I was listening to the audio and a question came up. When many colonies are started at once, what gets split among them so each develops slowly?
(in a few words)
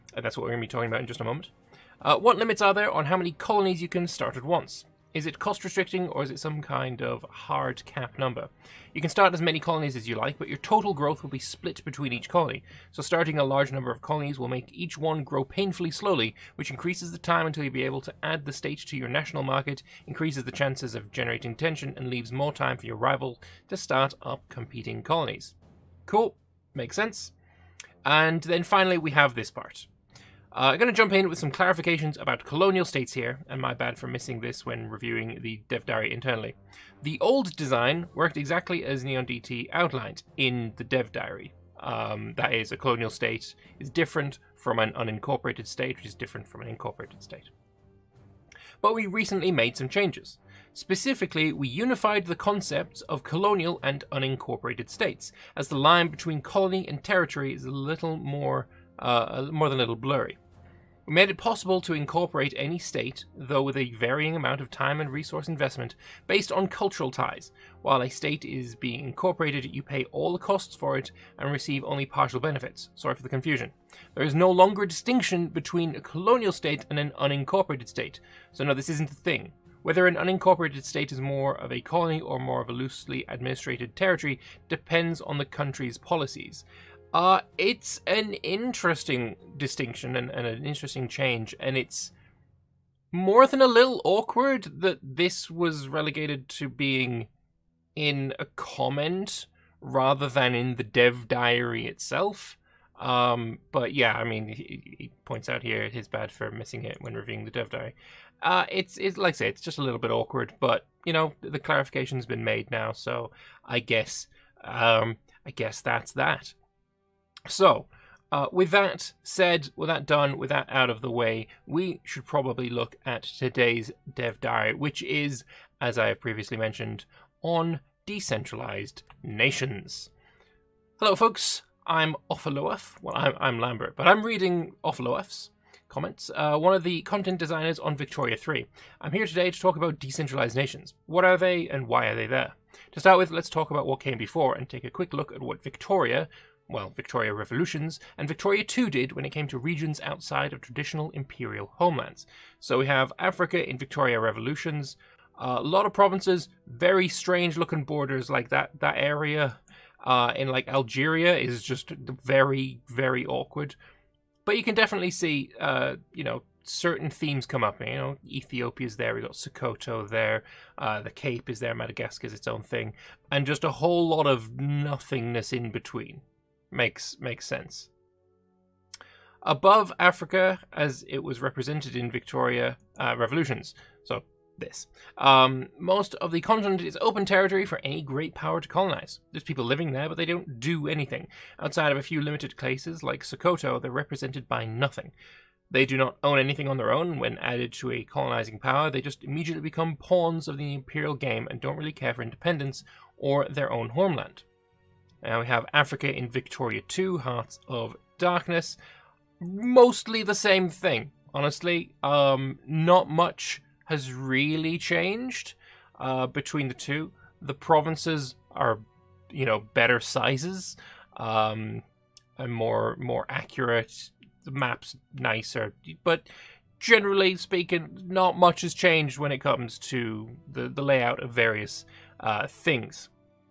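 Total growth.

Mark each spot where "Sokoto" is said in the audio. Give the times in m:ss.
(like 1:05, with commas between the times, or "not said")
2:49, 3:13.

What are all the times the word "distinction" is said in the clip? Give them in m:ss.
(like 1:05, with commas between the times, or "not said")
1:14, 1:29.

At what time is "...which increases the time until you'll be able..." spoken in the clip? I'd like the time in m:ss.
0:16.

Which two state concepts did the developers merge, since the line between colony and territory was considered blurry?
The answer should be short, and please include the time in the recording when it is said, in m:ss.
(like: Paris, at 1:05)
Colonial and unincorporated, at 0:53.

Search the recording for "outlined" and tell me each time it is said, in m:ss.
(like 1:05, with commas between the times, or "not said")
0:39.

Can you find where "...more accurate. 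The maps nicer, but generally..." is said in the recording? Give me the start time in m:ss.
3:42.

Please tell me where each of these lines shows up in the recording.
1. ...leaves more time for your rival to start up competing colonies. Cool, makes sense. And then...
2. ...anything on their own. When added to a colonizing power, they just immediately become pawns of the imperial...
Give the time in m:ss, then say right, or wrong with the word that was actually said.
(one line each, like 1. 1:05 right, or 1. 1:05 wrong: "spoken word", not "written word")
1. 0:22 right
2. 3:16 right.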